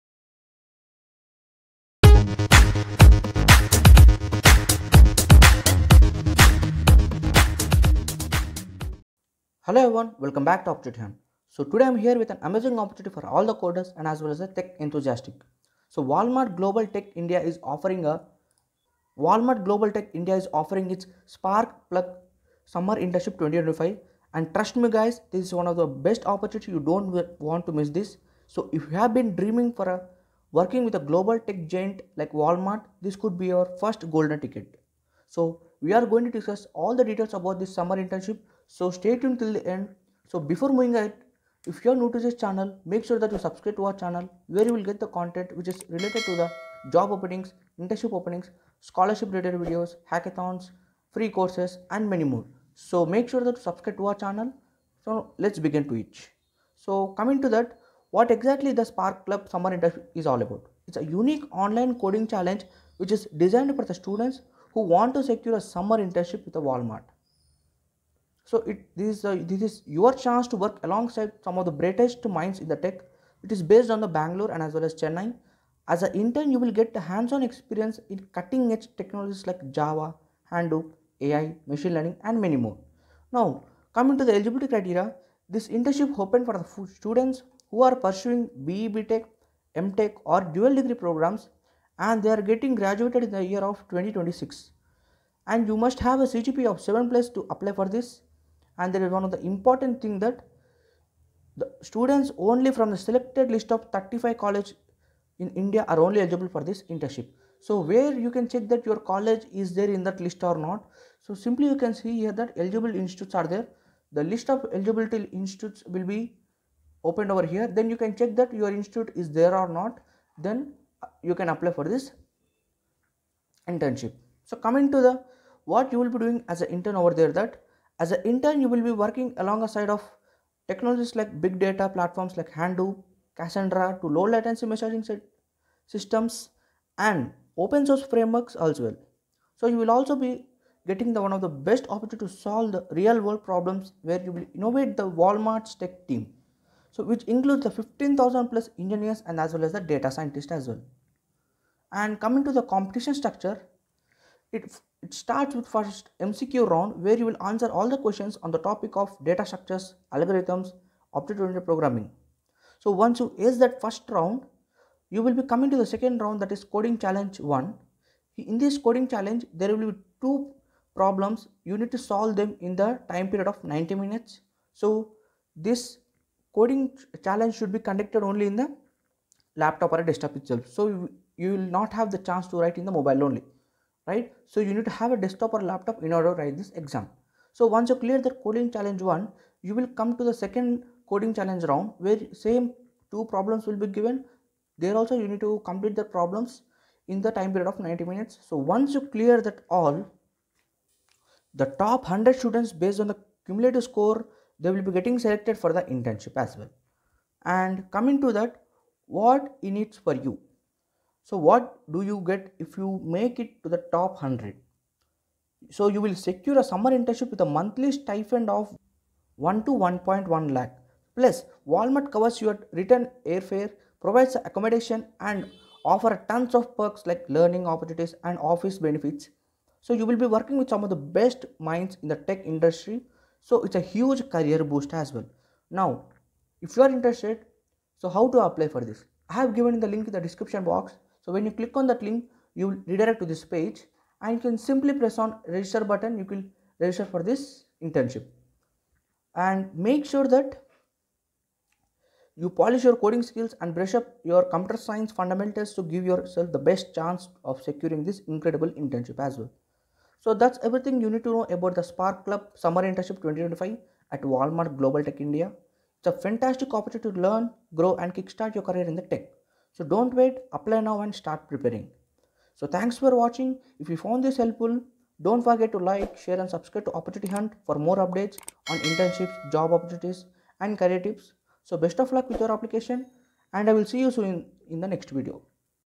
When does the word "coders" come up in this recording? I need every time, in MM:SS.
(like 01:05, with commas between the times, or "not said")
00:13.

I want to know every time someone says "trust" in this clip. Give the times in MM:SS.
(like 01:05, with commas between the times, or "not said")
00:24.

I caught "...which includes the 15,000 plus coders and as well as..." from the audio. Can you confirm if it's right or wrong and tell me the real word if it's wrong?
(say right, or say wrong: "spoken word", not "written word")
wrong: "engineers", not "coders".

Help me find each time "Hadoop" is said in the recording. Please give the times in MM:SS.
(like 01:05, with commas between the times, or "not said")
01:20, 02:12.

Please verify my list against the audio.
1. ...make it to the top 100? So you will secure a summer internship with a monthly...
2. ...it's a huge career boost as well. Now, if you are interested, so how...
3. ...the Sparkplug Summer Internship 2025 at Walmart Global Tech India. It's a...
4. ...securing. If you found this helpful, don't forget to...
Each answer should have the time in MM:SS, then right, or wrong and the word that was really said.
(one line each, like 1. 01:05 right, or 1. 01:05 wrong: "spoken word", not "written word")
1. 03:33 right
2. 03:53 right
3. 04:21 right
4. 04:33 wrong: "watching", not "securing".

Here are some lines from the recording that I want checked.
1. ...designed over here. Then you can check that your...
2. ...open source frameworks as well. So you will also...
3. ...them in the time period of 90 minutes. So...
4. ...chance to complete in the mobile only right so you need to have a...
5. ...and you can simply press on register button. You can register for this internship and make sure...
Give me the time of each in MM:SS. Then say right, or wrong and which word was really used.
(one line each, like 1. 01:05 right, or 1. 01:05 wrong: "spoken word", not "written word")
1. 01:57 wrong: "opened", not "designed"
2. 02:17 right
3. 02:52 right
4. 03:02 wrong: "write", not "complete"
5. 04:04 right.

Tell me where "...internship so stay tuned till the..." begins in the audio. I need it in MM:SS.
00:37.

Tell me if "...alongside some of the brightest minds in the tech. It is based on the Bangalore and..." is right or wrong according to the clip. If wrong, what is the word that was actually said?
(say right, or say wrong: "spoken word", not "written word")
right.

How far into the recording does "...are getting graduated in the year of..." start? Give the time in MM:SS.
01:32.